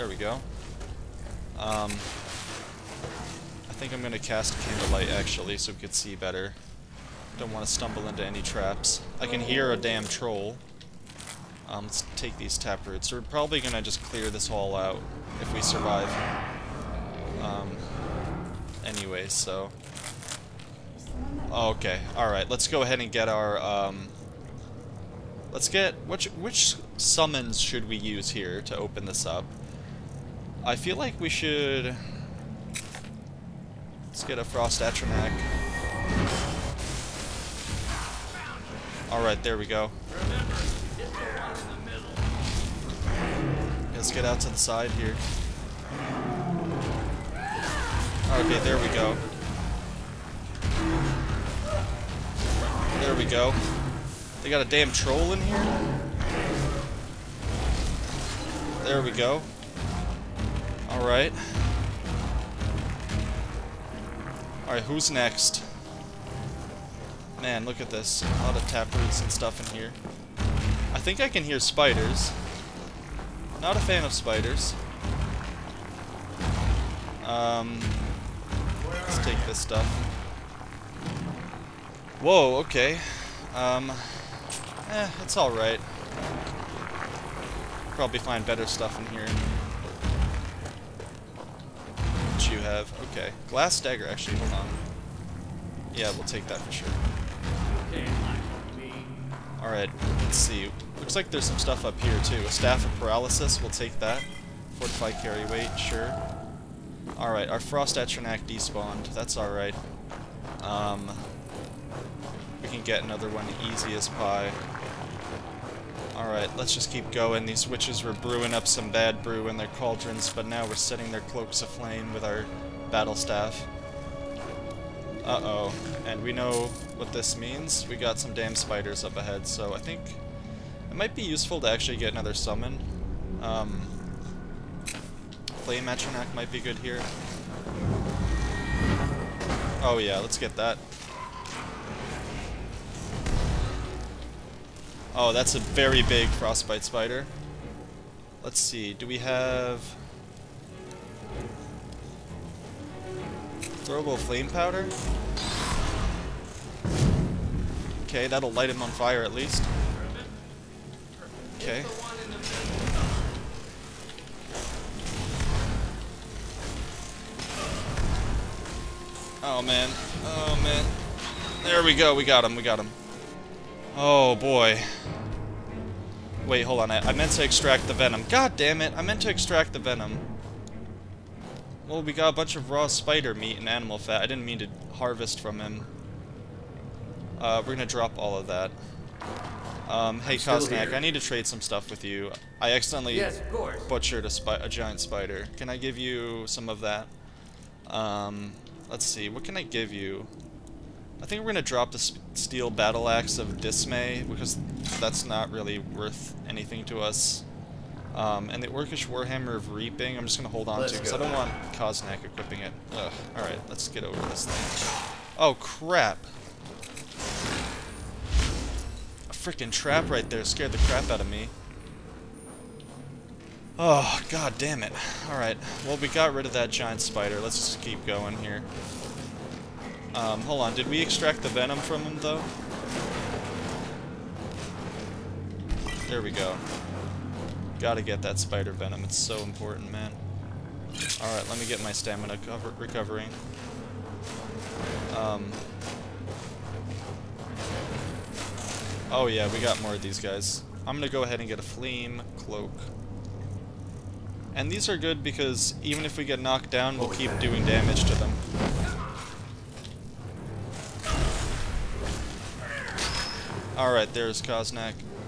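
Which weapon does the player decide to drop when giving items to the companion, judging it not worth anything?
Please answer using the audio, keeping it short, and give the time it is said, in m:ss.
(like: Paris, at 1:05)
Steel Battle Axe of Dismay, at 3:22.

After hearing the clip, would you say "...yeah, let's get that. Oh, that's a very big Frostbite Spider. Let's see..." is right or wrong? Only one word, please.
right.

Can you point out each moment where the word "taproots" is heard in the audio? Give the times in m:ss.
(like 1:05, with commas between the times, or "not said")
0:12, 1:08.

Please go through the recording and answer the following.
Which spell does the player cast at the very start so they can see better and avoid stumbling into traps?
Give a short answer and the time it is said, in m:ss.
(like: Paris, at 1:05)
Candlelight, at 0:04.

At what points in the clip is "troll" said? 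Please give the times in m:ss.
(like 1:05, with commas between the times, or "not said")
0:10, 0:54.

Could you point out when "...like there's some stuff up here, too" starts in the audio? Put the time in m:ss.
1:41.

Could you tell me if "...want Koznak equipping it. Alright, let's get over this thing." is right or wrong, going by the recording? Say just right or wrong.
right.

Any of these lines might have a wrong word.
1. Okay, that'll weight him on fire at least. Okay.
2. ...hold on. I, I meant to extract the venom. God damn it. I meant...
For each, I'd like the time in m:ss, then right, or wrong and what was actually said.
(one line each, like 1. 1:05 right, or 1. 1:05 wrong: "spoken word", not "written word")
1. 2:38 wrong: "light", not "weight"
2. 2:56 right.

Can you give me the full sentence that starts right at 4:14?
And these are good because even if we get knocked down, we'll keep doing damage to them.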